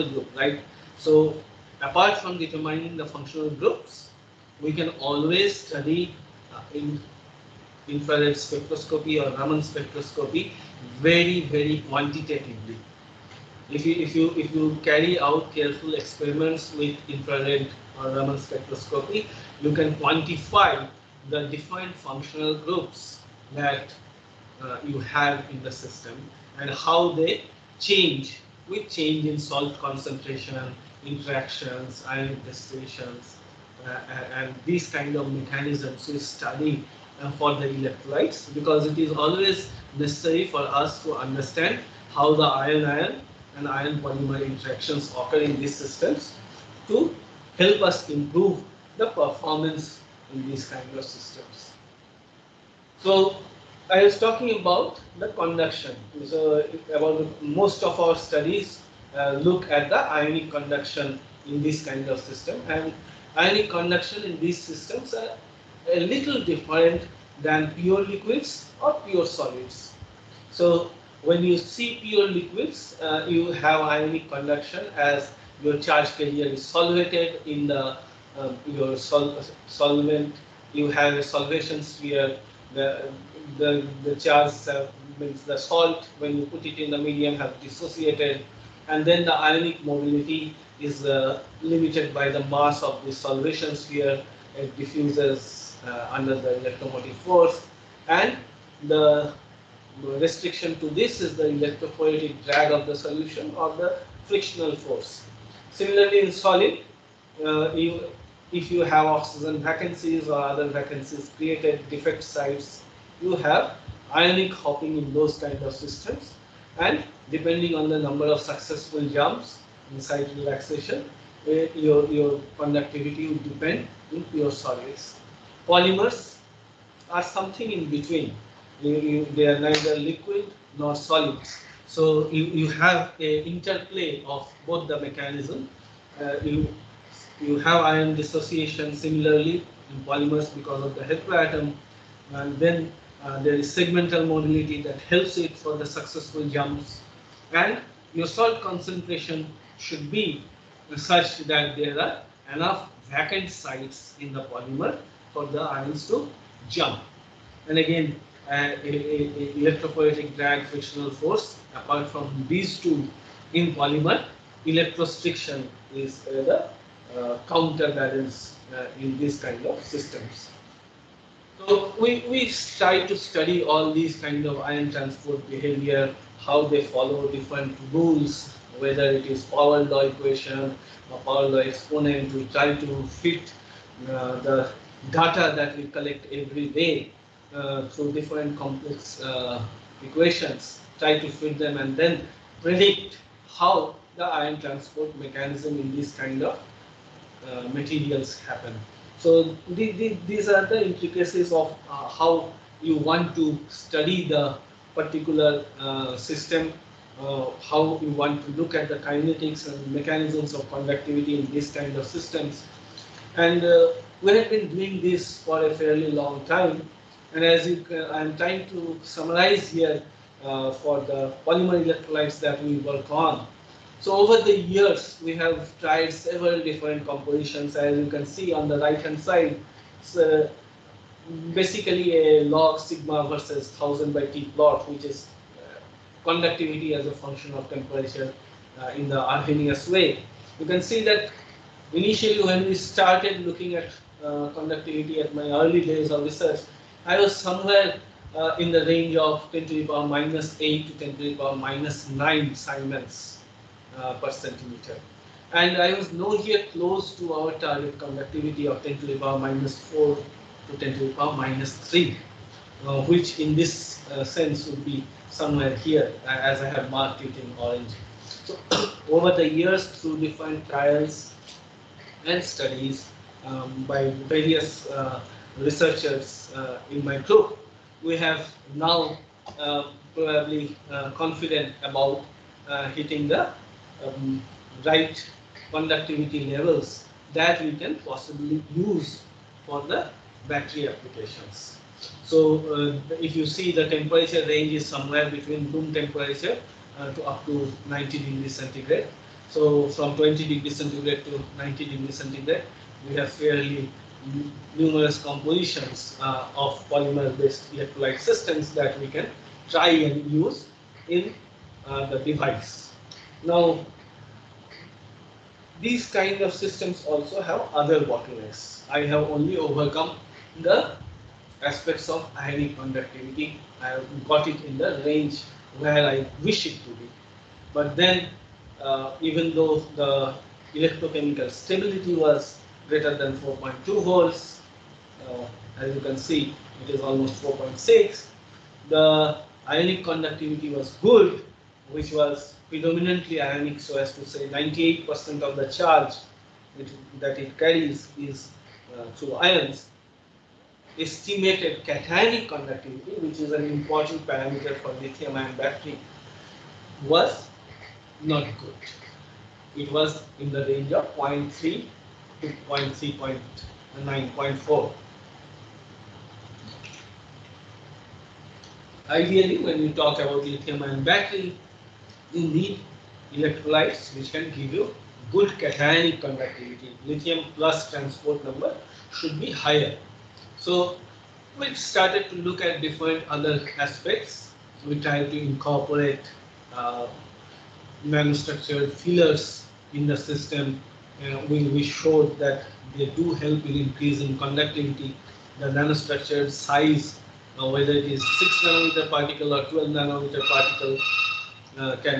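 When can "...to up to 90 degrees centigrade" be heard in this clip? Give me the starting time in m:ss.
4:57.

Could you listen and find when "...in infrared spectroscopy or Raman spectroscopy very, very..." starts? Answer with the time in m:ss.
0:06.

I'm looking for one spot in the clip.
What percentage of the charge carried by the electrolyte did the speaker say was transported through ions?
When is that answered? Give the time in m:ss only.
5:44.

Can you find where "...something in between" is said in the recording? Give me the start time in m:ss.
2:07.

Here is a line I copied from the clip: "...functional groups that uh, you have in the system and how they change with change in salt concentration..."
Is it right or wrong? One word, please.
right.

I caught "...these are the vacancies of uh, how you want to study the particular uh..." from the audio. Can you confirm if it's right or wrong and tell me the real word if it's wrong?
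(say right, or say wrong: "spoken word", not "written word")
wrong: "intricacies", not "vacancies".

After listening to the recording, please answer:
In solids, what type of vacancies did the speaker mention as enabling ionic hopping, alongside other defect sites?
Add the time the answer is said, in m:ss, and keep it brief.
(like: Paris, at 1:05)
Oxygen vacancies, at 1:49.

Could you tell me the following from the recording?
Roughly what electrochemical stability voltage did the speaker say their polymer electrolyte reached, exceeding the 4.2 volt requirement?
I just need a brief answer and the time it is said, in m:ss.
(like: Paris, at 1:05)
4.6 volts, at 5:37.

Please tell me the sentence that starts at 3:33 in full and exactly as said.
And uh, we have been doing this for a fairly long time.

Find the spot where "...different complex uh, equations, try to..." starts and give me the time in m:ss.
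3:08.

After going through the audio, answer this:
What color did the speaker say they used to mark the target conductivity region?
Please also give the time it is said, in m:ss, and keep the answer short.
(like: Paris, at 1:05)
Orange, at 4:27.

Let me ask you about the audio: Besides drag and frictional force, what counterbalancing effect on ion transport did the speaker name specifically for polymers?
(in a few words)
Electrostriction.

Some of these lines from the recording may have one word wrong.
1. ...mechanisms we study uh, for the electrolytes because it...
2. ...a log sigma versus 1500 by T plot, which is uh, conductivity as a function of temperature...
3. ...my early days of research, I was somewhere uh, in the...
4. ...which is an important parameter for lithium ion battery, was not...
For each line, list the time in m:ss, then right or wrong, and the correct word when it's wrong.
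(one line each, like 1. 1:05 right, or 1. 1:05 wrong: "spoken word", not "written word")
1. 0:35 right
2. 3:52 wrong: "1000", not "1500"
3. 4:05 right
4. 5:53 right.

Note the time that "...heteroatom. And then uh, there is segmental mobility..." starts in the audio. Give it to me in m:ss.
2:21.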